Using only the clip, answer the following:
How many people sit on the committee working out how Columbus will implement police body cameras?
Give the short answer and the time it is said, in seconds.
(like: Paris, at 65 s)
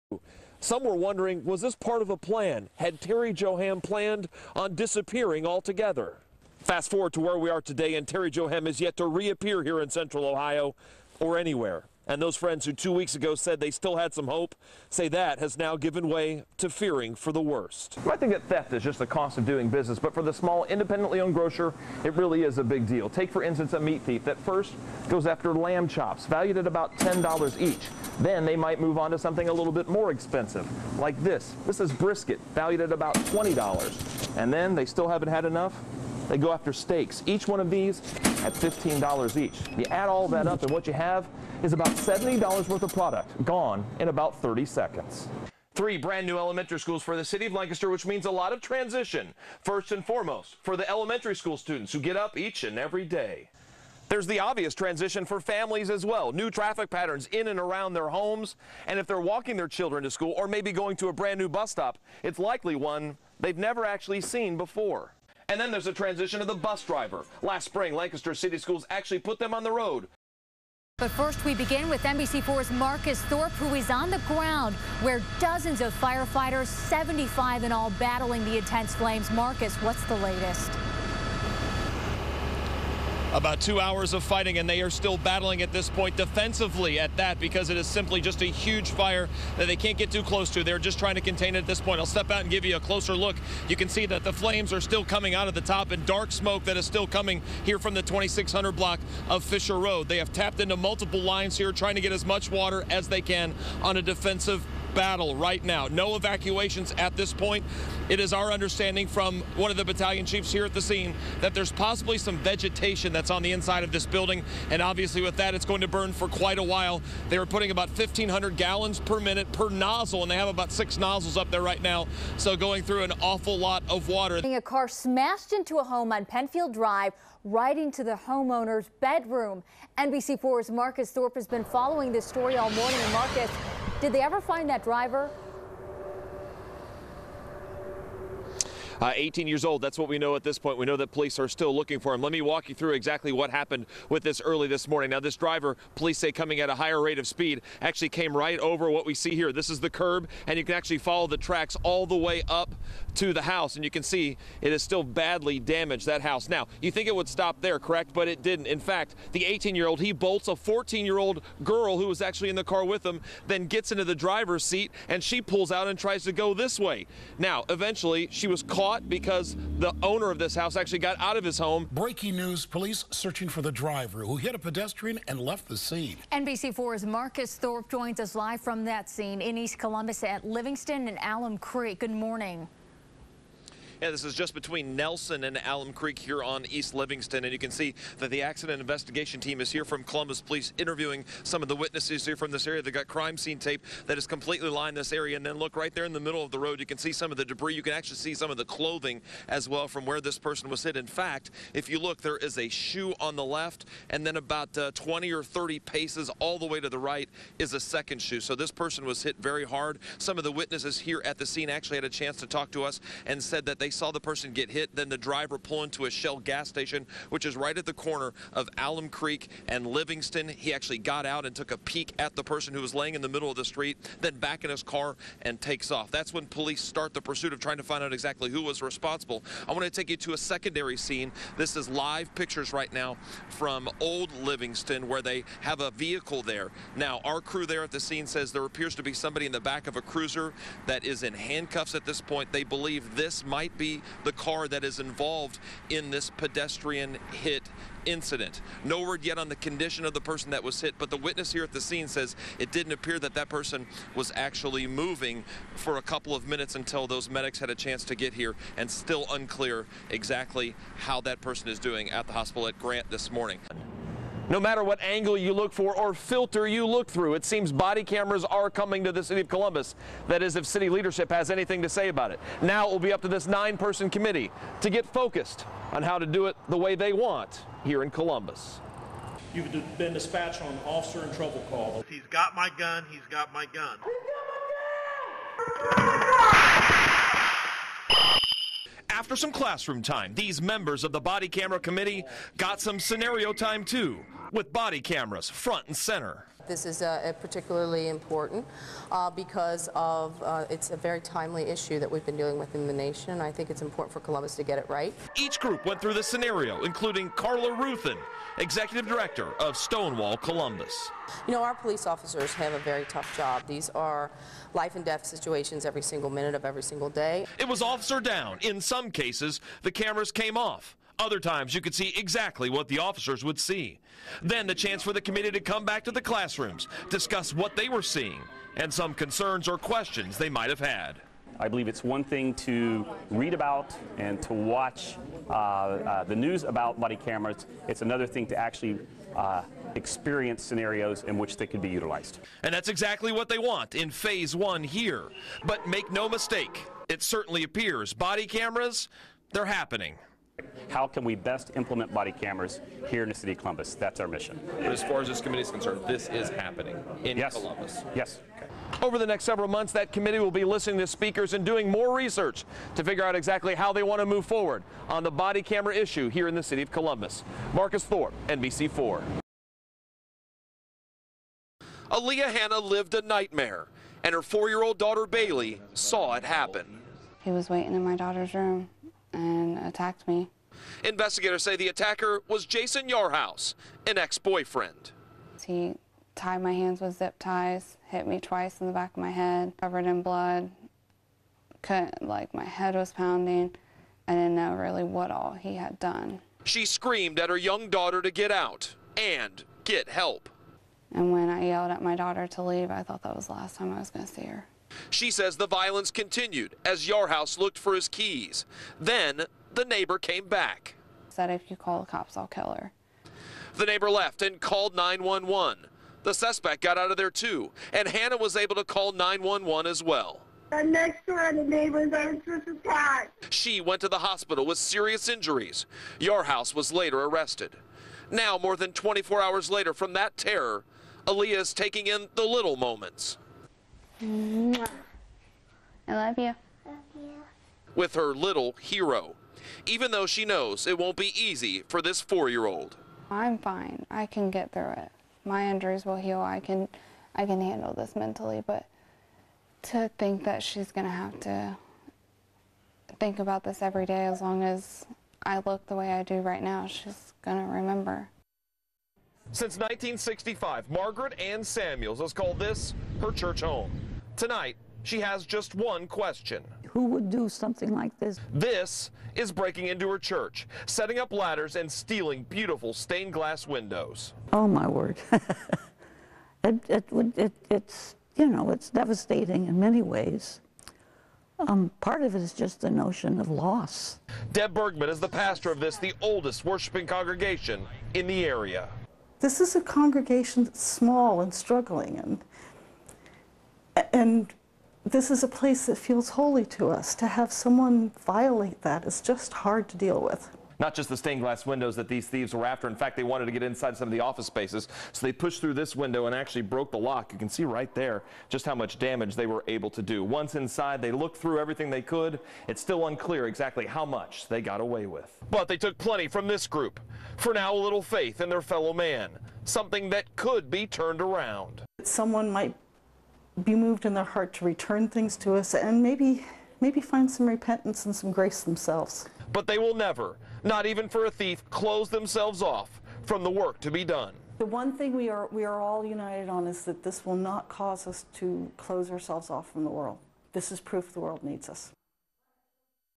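9, at 273 s.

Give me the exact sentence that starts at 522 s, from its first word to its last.
Someone might be moved in their heart to return things to us and maybe maybe find some repentance and some grace themselves.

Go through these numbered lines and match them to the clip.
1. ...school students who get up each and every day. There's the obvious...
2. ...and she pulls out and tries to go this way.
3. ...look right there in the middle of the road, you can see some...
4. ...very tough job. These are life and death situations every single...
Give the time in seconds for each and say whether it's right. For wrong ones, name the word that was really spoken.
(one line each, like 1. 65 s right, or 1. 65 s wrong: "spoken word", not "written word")
1. 51 s right
2. 165 s right
3. 195 s right
4. 312 s right.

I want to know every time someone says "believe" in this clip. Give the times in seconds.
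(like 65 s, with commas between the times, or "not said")
242 s, 331 s.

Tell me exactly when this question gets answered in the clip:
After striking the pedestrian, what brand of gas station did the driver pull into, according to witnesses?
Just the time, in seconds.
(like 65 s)
216 s.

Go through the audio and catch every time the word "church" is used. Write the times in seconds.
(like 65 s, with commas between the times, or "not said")
463 s, 470 s.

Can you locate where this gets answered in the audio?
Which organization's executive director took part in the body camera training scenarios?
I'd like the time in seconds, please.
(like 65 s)
309 s.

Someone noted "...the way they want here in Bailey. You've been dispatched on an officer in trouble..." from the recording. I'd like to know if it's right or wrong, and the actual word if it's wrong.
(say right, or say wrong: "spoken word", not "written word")
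wrong: "Columbus", not "Bailey".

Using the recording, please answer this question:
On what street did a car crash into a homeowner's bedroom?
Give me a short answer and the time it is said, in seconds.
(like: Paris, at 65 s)
Penfield Drive, at 126 s.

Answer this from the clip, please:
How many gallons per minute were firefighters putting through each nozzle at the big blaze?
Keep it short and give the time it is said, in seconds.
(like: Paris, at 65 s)
1,500, at 117 s.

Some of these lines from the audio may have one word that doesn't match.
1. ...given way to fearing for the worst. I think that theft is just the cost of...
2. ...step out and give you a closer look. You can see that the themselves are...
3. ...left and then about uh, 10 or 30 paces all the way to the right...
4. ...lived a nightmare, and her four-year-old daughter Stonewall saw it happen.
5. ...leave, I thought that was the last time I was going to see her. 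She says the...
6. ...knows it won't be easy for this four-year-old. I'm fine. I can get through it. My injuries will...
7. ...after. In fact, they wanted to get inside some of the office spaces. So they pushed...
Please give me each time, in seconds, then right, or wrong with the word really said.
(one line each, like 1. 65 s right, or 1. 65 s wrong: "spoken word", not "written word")
1. 15 s right
2. 92 s wrong: "flames", not "themselves"
3. 203 s wrong: "20", not "10"
4. 372 s wrong: "Bailey", not "Stonewall"
5. 402 s right
6. 440 s right
7. 502 s right.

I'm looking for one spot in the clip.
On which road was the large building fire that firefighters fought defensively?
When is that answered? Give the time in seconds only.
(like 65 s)
99 s.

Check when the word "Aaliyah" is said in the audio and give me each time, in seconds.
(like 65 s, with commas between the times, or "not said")
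372 s, 431 s.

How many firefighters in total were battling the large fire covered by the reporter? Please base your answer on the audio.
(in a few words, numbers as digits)
75.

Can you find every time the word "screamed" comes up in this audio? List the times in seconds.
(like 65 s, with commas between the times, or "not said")
396 s.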